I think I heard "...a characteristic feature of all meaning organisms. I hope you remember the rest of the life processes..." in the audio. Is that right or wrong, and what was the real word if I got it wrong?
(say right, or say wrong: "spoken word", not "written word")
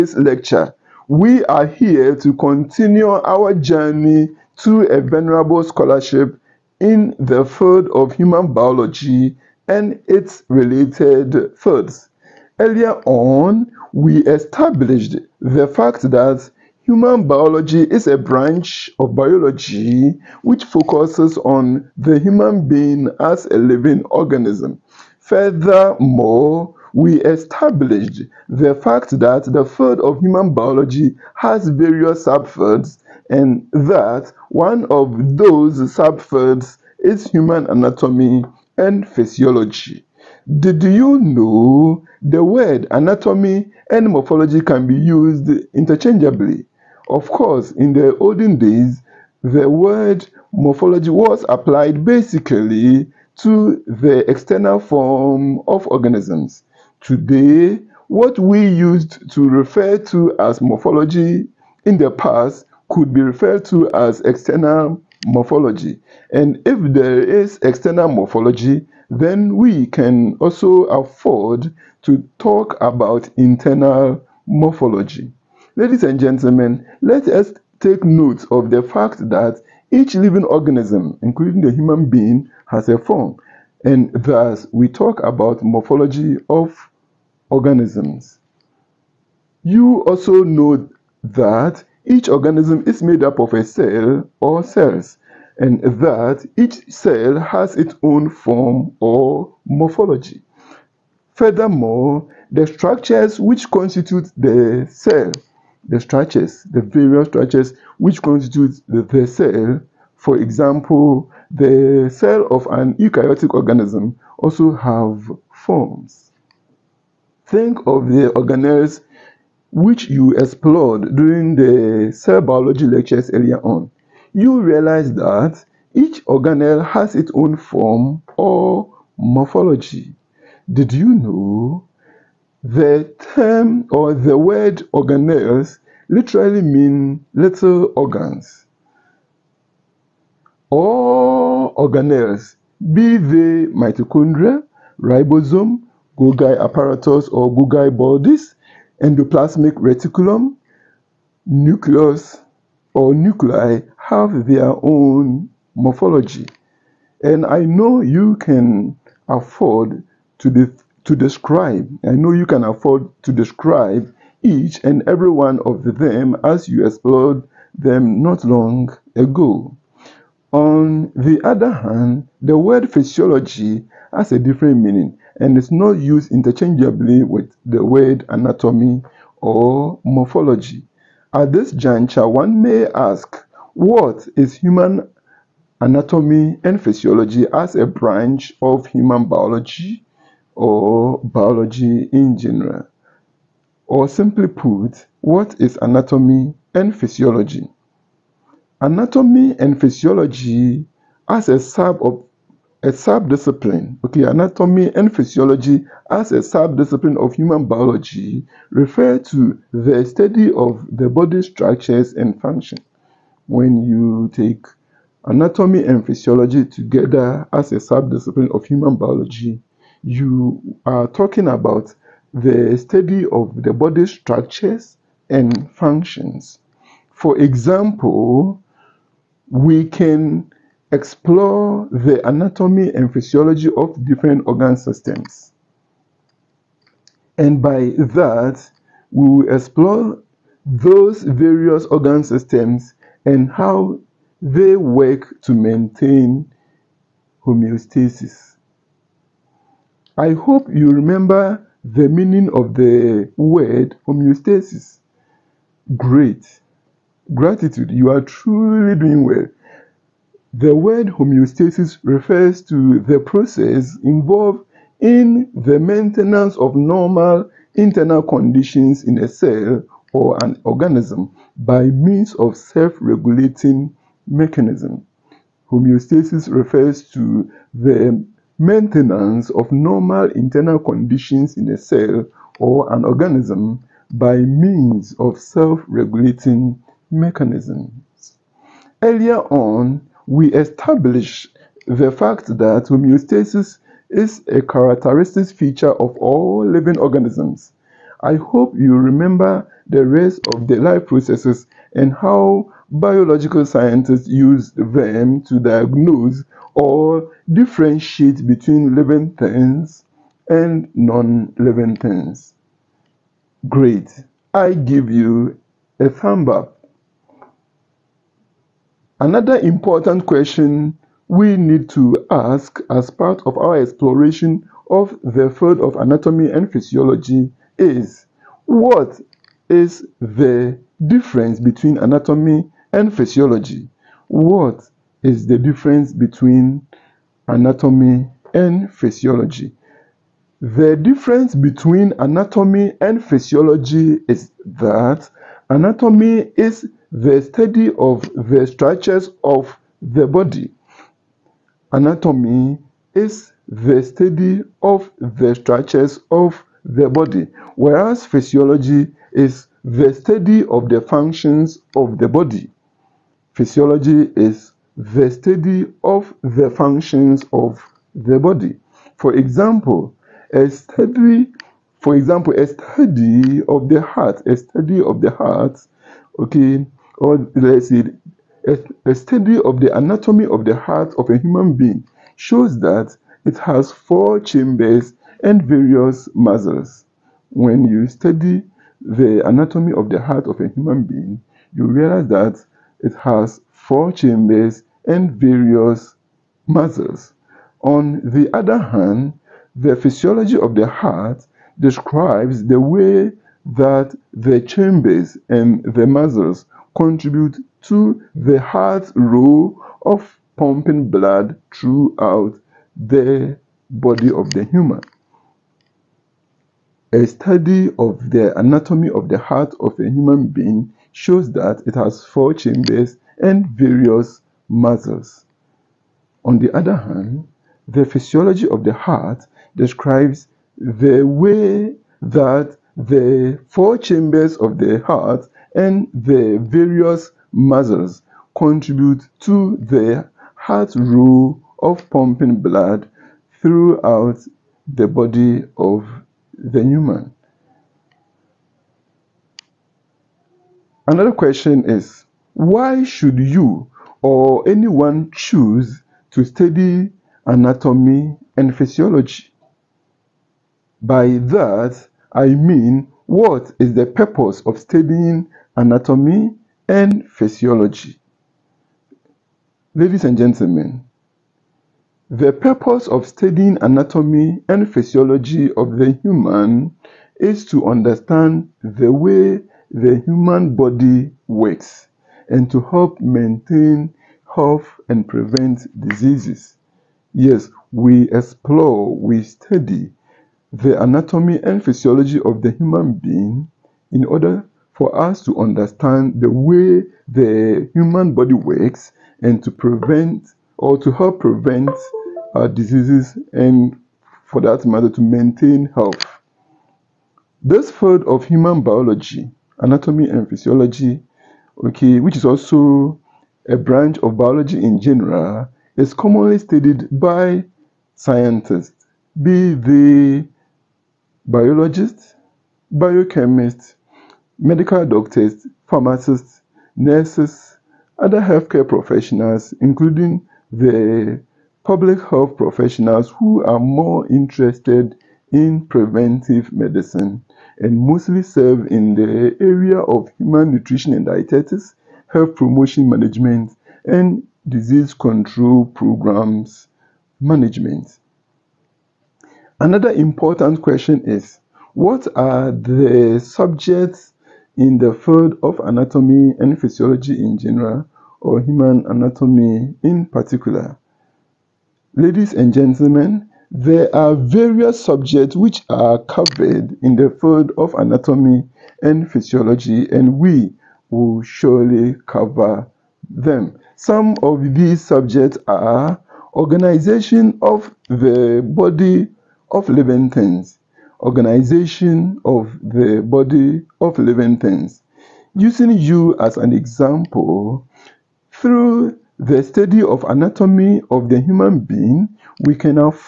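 wrong: "living", not "meaning".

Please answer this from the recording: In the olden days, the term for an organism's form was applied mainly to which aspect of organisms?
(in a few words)
external form.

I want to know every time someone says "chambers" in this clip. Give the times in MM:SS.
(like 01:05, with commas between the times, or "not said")
06:24, 06:34, 06:44, 07:02, 07:13.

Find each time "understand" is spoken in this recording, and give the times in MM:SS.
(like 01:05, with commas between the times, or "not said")
07:57, 08:15.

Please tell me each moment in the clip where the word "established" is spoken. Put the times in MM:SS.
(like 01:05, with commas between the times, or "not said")
00:14, 00:27, 04:50.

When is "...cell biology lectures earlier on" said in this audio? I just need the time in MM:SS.
02:02.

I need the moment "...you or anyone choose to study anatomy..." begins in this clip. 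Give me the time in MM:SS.
07:33.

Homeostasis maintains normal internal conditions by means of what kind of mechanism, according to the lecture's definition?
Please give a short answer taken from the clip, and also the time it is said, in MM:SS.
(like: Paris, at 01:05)
self-regulating mechanism, at 04:32.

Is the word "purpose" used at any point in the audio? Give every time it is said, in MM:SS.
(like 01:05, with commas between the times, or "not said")
07:44, 07:52.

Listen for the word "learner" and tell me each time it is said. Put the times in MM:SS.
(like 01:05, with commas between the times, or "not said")
not said.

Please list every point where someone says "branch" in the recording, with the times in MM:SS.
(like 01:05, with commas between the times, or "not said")
00:18, 03:07, 08:33.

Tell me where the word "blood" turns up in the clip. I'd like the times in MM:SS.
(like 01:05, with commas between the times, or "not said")
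06:51, 07:22.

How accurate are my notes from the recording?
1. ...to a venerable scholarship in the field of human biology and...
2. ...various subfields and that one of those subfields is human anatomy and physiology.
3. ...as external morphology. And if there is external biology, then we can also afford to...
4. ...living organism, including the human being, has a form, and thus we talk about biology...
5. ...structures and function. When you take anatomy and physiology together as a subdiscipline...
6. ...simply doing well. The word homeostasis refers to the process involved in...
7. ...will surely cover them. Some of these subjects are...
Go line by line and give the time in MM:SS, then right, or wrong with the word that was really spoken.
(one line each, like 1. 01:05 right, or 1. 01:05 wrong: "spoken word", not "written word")
1. 00:04 right
2. 00:31 right
3. 01:03 wrong: "morphology", not "biology"
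4. 01:20 wrong: "morphology", not "biology"
5. 03:31 right
6. 04:18 wrong: "truly", not "simply"
7. 09:31 right.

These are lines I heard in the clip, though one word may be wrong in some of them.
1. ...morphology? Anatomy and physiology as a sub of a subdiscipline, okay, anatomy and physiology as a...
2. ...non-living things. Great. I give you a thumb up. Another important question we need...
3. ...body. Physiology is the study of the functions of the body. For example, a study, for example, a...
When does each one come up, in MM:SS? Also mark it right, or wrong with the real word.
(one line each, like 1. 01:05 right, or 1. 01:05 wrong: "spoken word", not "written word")
1. 03:16 wrong: "physiology", not "morphology"
2. 05:10 right
3. 06:02 right.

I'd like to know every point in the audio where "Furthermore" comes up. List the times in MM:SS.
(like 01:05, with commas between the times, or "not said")
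00:25, 01:41.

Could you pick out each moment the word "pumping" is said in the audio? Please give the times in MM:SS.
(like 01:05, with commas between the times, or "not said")
06:50, 07:22.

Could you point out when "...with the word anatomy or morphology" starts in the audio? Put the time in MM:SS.
02:57.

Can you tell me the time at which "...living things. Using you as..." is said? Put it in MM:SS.
09:44.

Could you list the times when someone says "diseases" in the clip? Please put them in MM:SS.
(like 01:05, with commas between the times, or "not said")
08:06, 08:22, 09:04.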